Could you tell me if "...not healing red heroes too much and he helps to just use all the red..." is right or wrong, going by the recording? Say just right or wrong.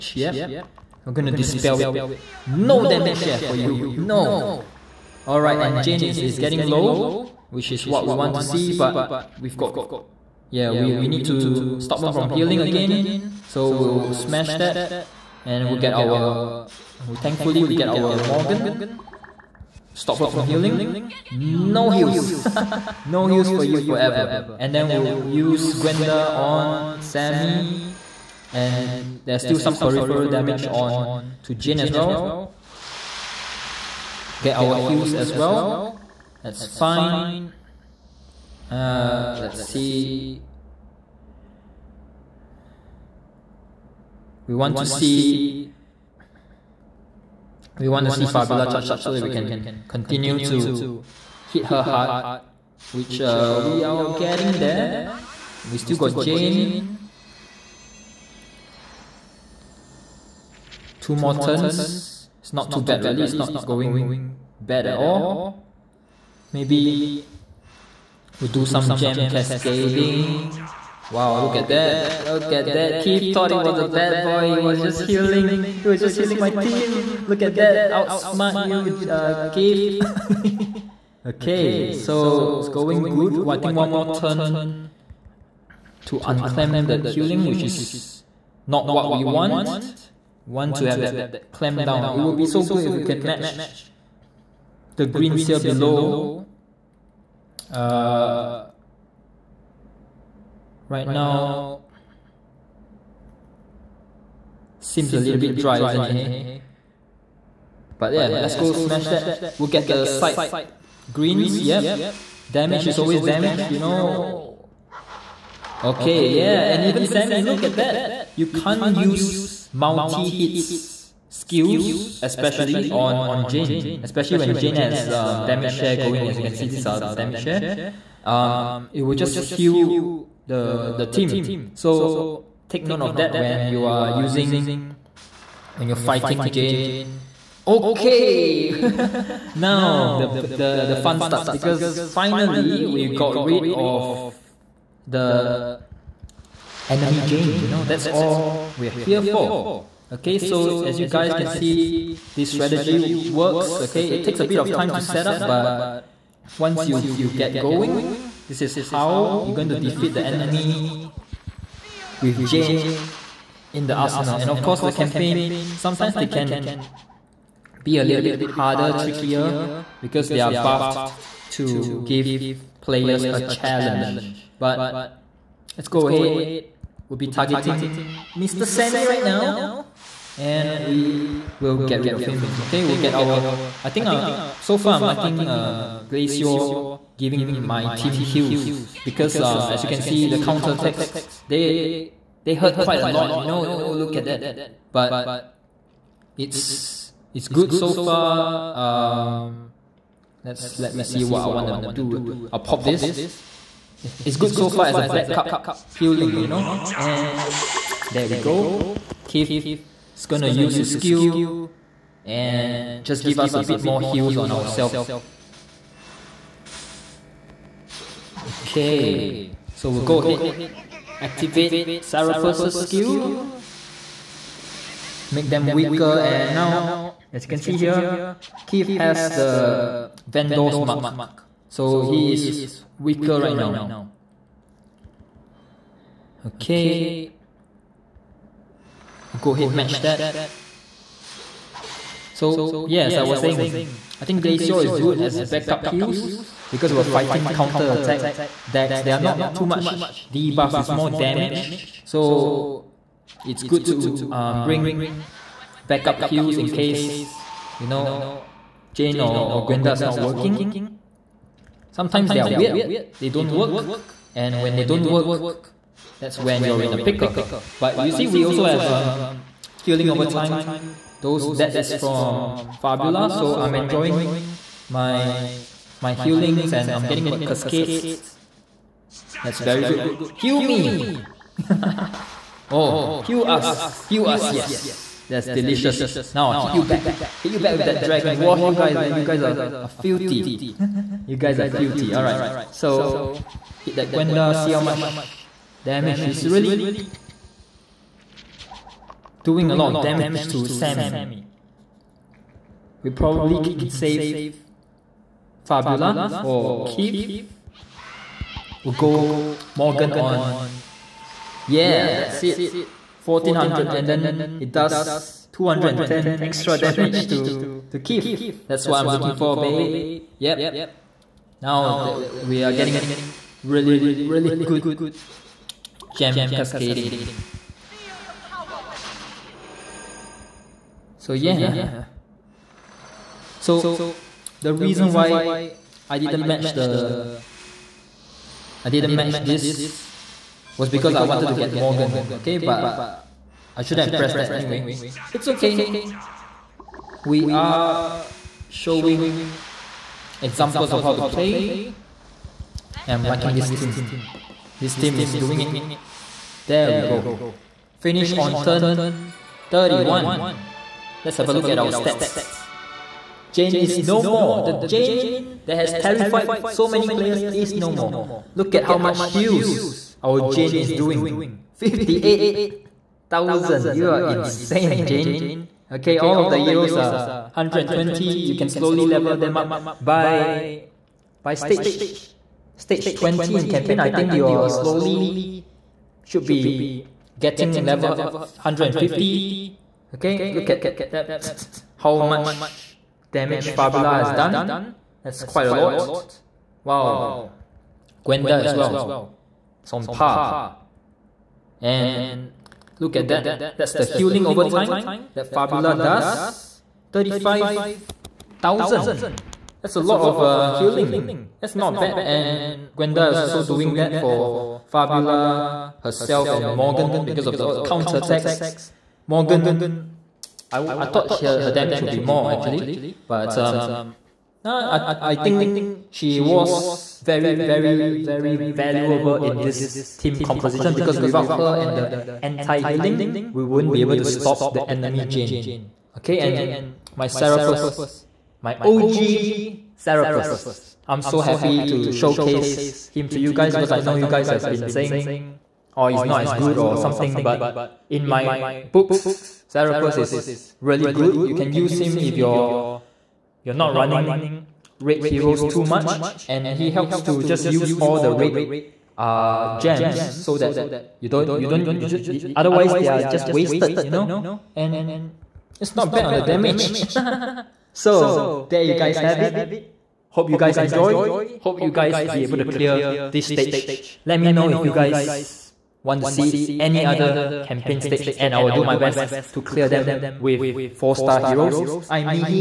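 wrong.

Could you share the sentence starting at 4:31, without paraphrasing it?
Those that is from Fabula, so I'm enjoying my my healings and I'm getting my cascades that's very good.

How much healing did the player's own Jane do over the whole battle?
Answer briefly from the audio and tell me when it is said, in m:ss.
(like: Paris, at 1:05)
58,000, at 6:11.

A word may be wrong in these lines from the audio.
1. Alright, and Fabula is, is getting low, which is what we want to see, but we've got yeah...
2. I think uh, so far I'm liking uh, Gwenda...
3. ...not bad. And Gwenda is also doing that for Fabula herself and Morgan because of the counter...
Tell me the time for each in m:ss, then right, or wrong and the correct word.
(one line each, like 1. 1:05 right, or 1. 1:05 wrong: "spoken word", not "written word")
1. 0:05 wrong: "Jane", not "Fabula"
2. 3:03 wrong: "Glacior", not "Gwenda"
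3. 6:51 right.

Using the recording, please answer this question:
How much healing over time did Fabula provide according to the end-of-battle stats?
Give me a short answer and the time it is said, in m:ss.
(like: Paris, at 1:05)
35,000, at 6:47.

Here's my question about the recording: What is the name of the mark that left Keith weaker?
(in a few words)
Vendor's Mark.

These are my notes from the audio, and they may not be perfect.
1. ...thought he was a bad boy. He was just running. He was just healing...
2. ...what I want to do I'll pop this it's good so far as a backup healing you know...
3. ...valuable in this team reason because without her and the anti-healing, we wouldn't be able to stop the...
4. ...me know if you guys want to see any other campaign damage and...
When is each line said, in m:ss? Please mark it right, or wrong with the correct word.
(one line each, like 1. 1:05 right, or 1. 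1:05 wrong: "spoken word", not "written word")
1. 1:13 wrong: "healing", not "running"
2. 3:21 right
3. 7:08 wrong: "composition", not "reason"
4. 7:54 wrong: "stage", not "damage".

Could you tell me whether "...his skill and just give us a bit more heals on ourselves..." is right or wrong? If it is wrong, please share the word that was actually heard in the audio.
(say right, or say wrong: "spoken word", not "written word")
right.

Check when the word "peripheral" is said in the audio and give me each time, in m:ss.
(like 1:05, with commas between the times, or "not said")
0:29.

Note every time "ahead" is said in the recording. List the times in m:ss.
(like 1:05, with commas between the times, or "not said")
2:56, 3:40, 3:59.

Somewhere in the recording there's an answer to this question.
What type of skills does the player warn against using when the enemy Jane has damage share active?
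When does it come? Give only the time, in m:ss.
1:59.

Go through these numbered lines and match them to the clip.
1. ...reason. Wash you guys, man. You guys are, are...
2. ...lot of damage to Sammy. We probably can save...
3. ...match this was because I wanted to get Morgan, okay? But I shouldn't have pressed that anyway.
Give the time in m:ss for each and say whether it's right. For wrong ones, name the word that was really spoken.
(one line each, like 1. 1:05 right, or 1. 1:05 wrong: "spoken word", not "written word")
1. 4:48 wrong: "dragon", not "reason"
2. 4:59 right
3. 5:39 right.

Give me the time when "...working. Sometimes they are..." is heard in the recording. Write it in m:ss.
4:20.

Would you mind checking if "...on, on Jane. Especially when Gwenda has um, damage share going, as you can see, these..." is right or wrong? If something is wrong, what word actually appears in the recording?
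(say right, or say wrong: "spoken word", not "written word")
wrong: "Jane", not "Gwenda".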